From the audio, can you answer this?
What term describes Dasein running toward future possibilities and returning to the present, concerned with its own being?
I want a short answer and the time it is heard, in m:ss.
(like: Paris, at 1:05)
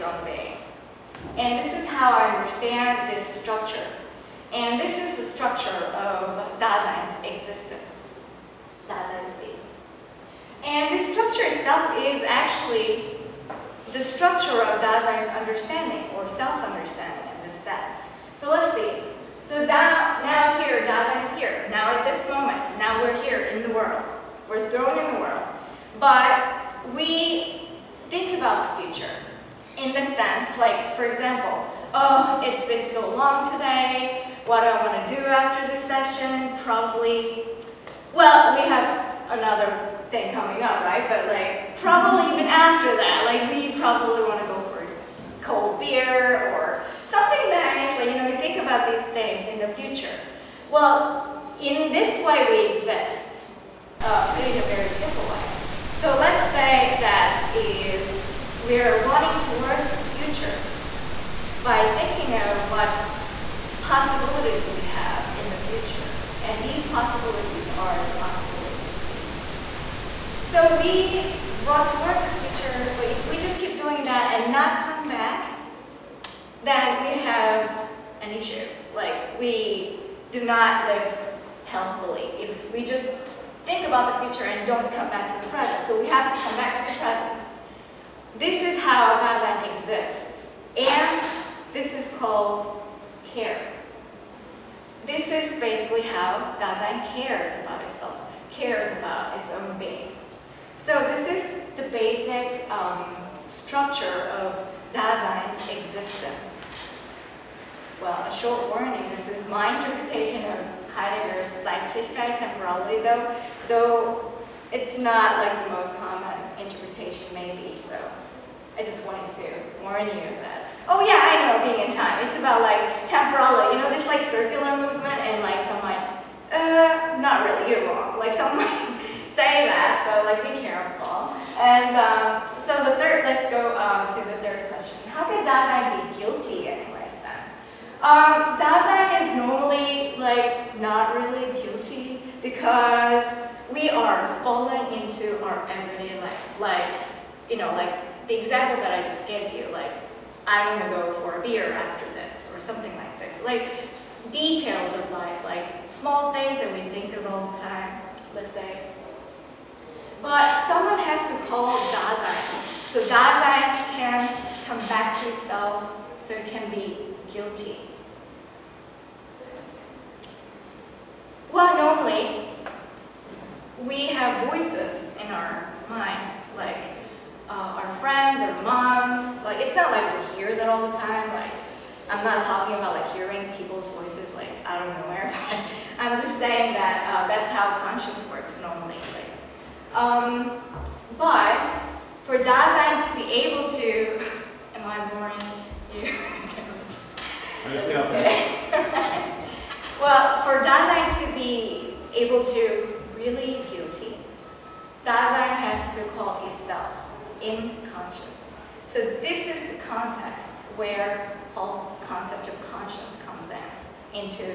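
care, at 1:33.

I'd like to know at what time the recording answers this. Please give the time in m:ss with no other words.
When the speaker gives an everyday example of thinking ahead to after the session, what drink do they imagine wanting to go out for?
0:45.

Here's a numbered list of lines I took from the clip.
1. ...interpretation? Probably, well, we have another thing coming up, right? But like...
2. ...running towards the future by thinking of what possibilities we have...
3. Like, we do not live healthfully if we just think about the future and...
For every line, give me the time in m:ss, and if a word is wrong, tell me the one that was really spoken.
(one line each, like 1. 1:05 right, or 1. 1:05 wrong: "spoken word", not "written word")
1. 0:35 wrong: "session", not "interpretation"
2. 0:59 right
3. 1:18 right.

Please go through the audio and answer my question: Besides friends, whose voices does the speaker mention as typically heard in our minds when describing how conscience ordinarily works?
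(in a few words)
our moms.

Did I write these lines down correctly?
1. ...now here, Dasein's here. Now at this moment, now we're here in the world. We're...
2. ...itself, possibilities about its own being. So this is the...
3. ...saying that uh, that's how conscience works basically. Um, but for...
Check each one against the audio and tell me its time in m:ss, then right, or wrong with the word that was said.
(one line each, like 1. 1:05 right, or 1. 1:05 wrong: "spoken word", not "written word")
1. 0:20 right
2. 1:37 wrong: "cares", not "possibilities"
3. 3:06 wrong: "normally", not "basically".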